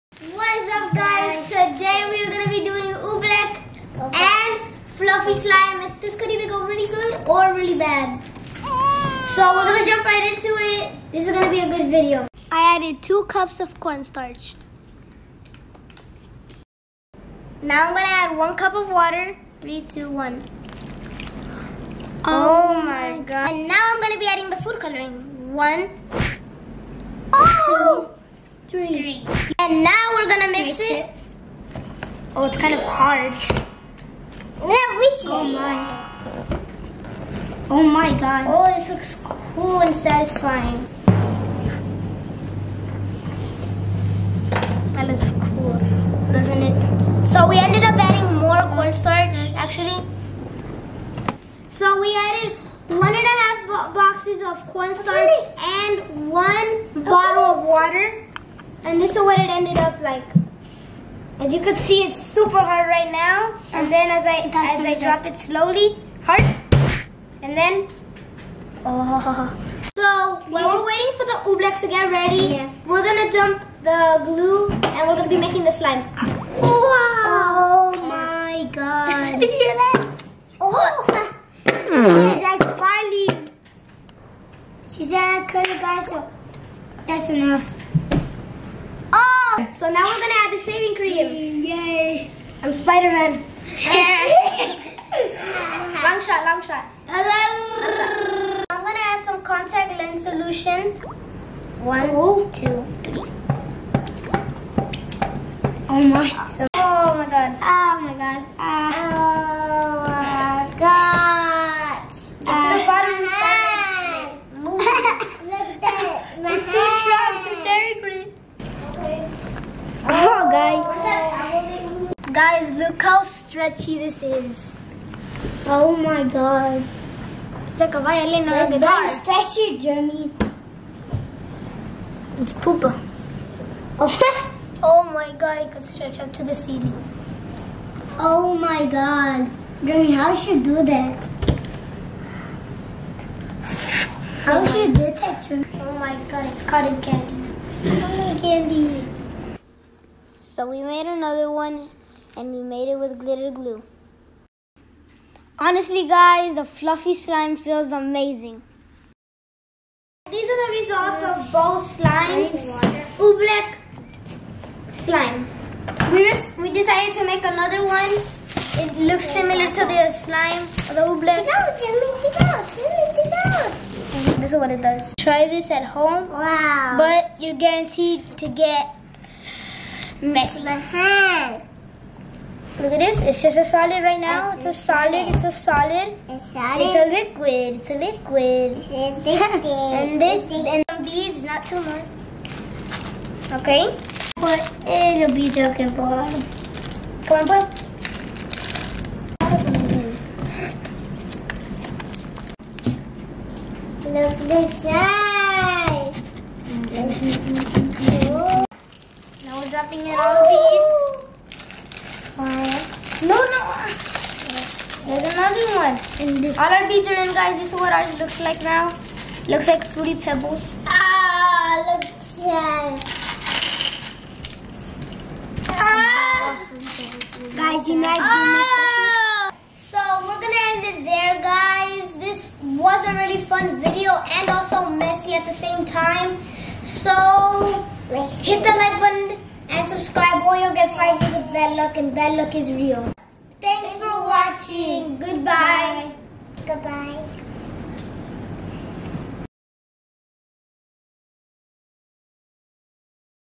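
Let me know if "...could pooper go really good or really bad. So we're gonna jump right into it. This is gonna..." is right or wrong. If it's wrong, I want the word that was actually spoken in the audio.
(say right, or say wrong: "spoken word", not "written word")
wrong: "either", not "pooper".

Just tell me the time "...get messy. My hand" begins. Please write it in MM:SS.
02:58.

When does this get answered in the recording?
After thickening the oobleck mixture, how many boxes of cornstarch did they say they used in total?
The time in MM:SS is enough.
00:52.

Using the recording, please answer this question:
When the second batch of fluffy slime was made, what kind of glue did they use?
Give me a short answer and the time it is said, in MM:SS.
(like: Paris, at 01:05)
glitter glue, at 02:33.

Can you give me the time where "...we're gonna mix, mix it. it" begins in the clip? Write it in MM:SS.
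00:30.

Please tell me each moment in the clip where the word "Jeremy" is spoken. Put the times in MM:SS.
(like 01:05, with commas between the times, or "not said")
02:09, 02:19, 02:25.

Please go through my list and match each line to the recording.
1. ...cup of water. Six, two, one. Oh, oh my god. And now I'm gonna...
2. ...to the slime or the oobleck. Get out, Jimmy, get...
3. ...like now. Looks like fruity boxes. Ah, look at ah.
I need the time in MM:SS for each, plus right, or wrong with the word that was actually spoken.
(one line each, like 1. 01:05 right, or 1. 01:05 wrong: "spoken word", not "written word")
1. 00:18 wrong: "Three", not "Six"
2. 02:49 right
3. 03:38 wrong: "pebbles", not "boxes".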